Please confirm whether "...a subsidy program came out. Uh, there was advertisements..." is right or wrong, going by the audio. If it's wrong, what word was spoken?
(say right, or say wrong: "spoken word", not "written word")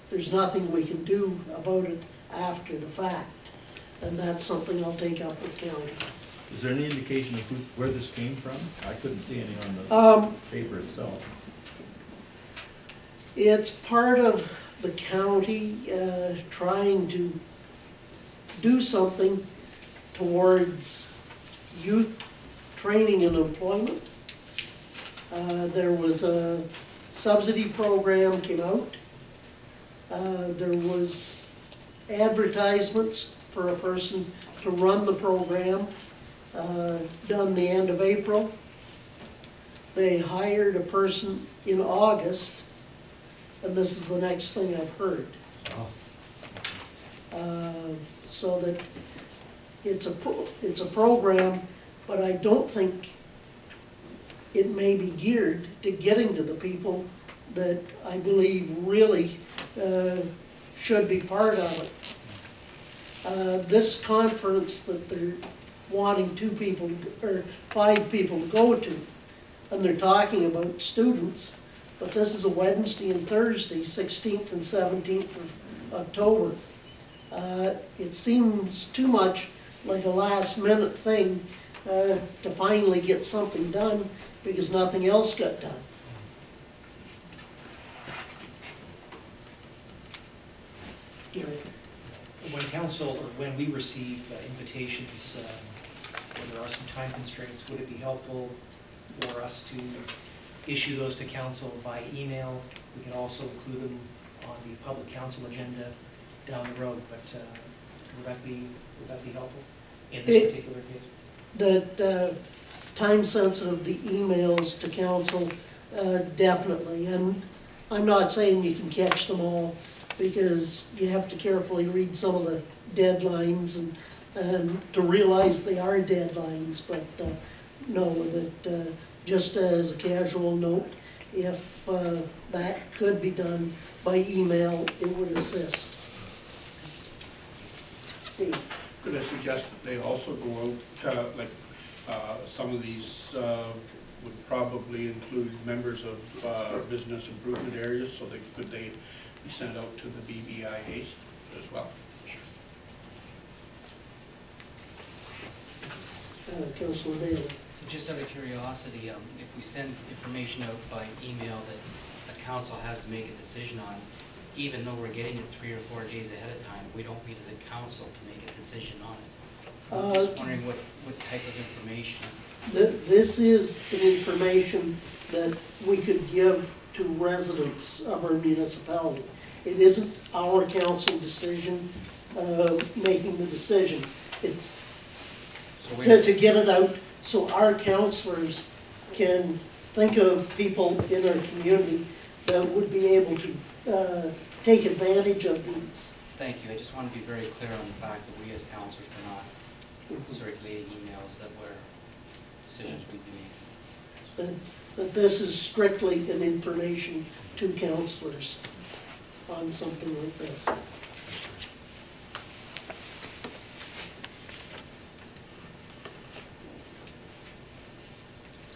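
right.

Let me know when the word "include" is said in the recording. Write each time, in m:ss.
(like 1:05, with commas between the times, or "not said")
1:43, 2:25.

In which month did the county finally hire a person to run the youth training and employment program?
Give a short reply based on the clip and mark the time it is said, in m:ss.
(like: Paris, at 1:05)
August, at 0:41.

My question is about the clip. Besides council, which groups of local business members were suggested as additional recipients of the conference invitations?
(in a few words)
business improvement areas.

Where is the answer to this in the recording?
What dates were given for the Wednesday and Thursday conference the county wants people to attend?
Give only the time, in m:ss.
1:13.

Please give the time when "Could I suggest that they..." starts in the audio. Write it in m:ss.
2:18.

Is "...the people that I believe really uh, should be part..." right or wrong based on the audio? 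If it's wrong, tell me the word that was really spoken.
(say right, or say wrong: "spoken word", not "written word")
right.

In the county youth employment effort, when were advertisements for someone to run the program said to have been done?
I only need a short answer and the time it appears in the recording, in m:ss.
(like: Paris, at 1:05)
end of April, at 0:37.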